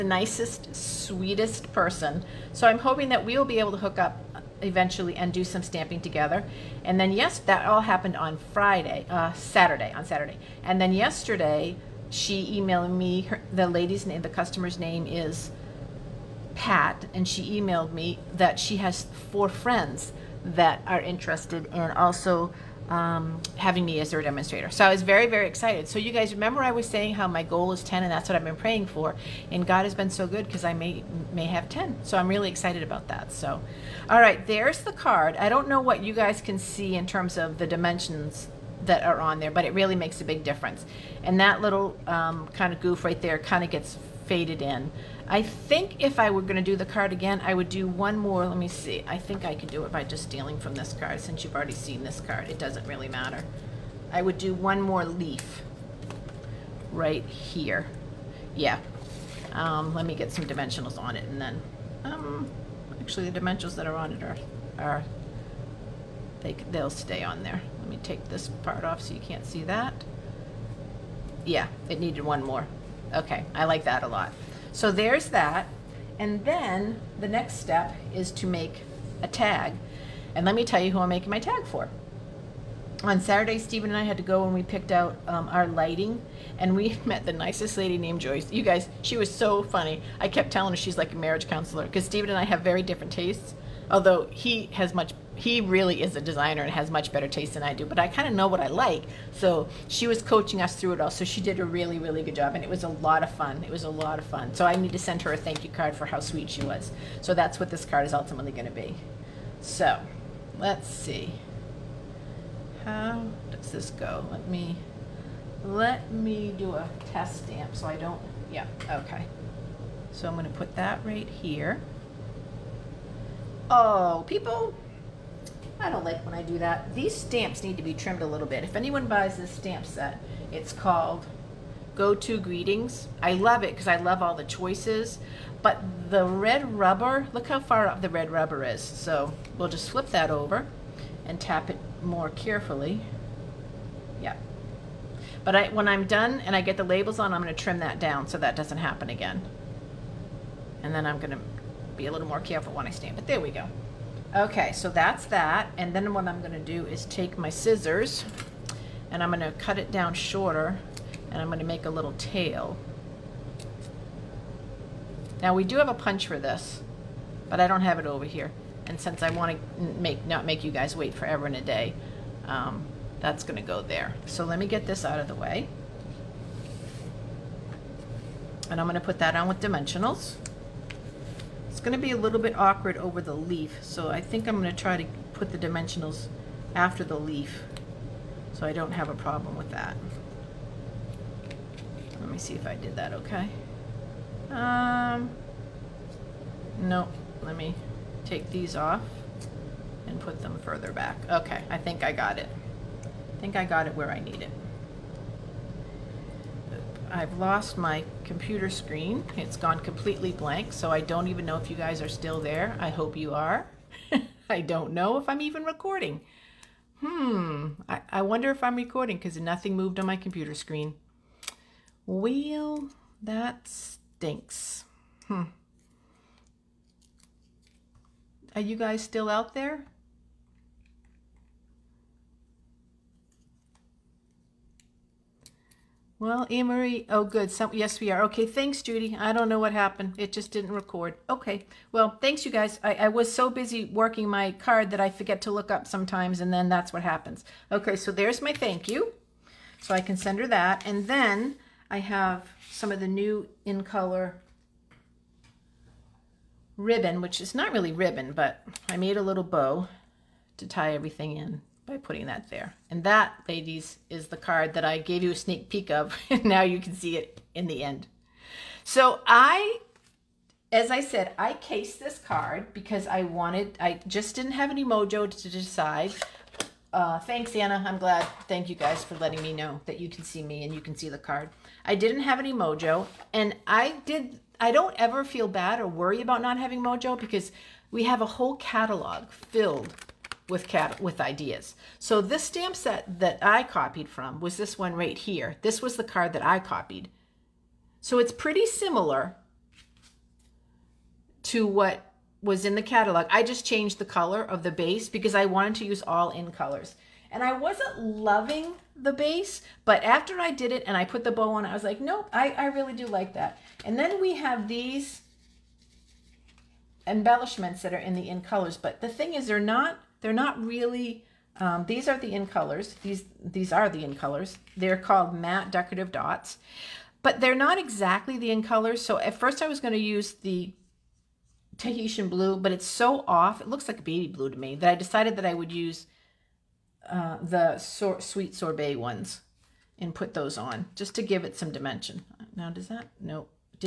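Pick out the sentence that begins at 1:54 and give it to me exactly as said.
Let me let me do a test stamp so I don't.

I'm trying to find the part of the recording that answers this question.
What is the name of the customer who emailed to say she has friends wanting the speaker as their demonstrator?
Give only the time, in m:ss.
0:16.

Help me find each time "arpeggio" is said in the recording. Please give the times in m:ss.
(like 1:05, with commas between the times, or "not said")
not said.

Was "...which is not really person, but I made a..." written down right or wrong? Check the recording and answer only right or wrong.
wrong.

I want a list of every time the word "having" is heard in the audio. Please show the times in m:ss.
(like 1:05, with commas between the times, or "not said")
0:23, 4:46.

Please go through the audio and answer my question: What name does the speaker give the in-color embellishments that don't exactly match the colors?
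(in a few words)
matte decorative dots.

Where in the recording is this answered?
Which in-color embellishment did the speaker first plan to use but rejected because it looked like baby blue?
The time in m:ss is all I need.
5:31.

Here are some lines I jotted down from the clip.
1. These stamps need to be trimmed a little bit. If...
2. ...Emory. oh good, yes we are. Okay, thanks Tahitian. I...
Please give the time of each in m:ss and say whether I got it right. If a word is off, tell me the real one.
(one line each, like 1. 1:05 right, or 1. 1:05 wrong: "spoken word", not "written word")
1. 2:06 right
2. 3:56 wrong: "Judy", not "Tahitian".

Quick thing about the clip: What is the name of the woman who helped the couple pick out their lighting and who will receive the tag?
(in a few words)
Joyce.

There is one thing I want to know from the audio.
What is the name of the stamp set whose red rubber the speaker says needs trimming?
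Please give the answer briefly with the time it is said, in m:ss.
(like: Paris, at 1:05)
Go To Greetings, at 2:11.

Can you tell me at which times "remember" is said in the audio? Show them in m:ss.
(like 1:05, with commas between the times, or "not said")
0:26.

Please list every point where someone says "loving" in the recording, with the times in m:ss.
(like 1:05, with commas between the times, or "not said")
5:08.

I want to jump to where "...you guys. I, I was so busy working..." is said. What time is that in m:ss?
4:02.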